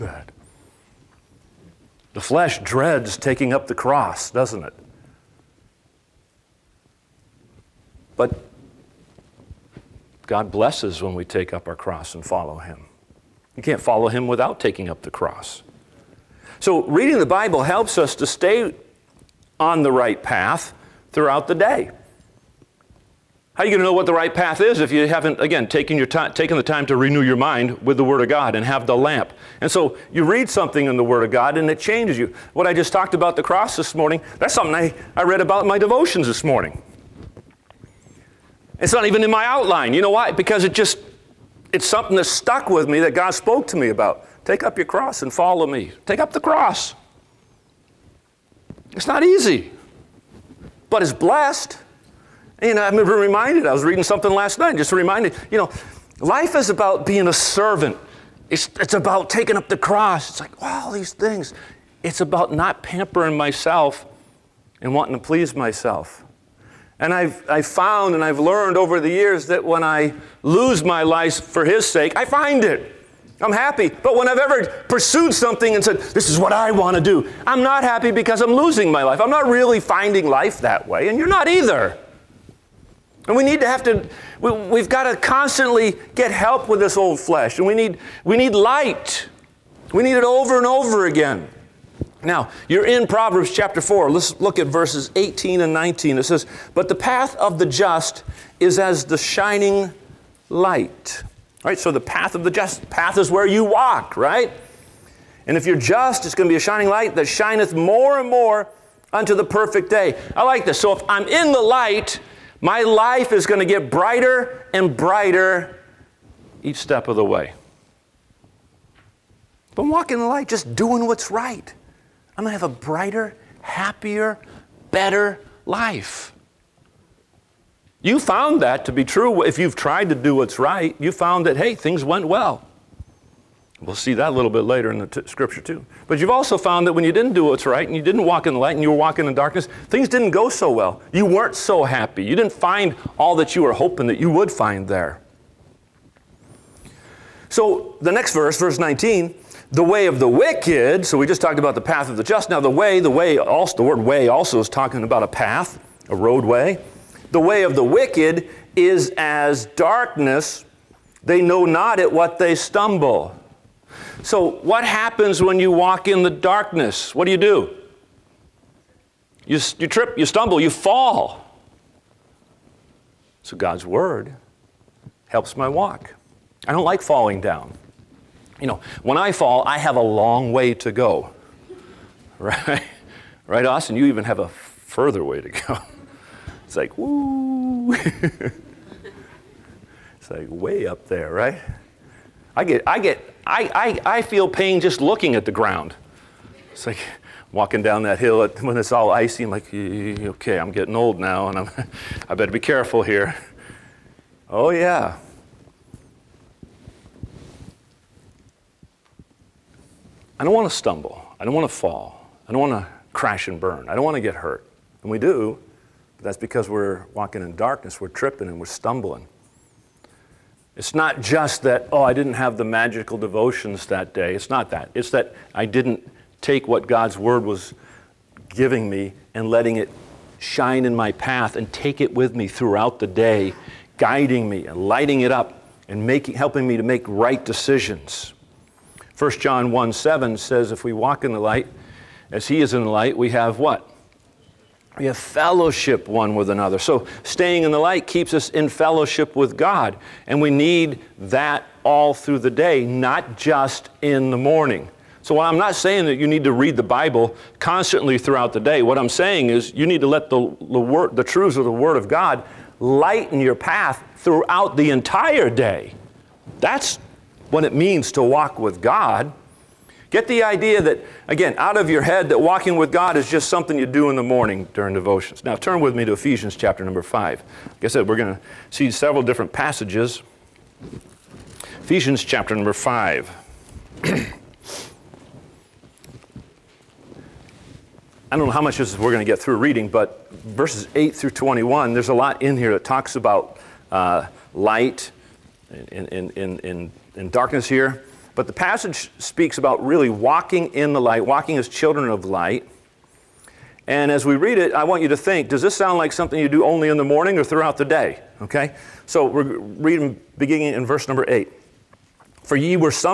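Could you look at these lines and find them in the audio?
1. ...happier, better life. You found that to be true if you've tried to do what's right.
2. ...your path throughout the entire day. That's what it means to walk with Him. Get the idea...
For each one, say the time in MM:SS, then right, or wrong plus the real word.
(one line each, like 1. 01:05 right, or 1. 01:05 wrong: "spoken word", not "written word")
1. 02:03 right
2. 04:23 wrong: "God", not "Him".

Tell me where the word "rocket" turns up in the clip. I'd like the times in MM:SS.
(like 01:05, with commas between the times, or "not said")
not said.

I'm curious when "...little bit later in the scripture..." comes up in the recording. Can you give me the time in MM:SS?
02:14.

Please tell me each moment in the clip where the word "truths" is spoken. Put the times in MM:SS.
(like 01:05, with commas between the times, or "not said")
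04:21.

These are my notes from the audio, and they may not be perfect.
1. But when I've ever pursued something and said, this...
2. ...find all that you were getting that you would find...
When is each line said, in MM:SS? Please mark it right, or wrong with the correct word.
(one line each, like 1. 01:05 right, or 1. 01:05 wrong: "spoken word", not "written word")
1. 01:13 right
2. 02:22 wrong: "hoping", not "getting".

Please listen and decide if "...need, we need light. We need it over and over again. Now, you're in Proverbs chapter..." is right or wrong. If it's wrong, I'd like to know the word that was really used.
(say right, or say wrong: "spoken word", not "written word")
right.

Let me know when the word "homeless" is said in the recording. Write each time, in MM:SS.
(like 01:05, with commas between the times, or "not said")
not said.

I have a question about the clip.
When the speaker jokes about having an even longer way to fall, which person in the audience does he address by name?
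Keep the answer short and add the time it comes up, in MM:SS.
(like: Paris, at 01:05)
Austin, at 03:03.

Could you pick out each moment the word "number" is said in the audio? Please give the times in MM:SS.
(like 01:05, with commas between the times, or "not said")
04:36, 04:42, 05:11.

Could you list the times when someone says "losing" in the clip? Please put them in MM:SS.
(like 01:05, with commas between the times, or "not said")
01:18.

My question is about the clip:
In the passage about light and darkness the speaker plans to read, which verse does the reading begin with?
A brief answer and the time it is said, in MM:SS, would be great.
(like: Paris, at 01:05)
8, at 05:10.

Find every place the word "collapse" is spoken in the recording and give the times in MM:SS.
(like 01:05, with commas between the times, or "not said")
not said.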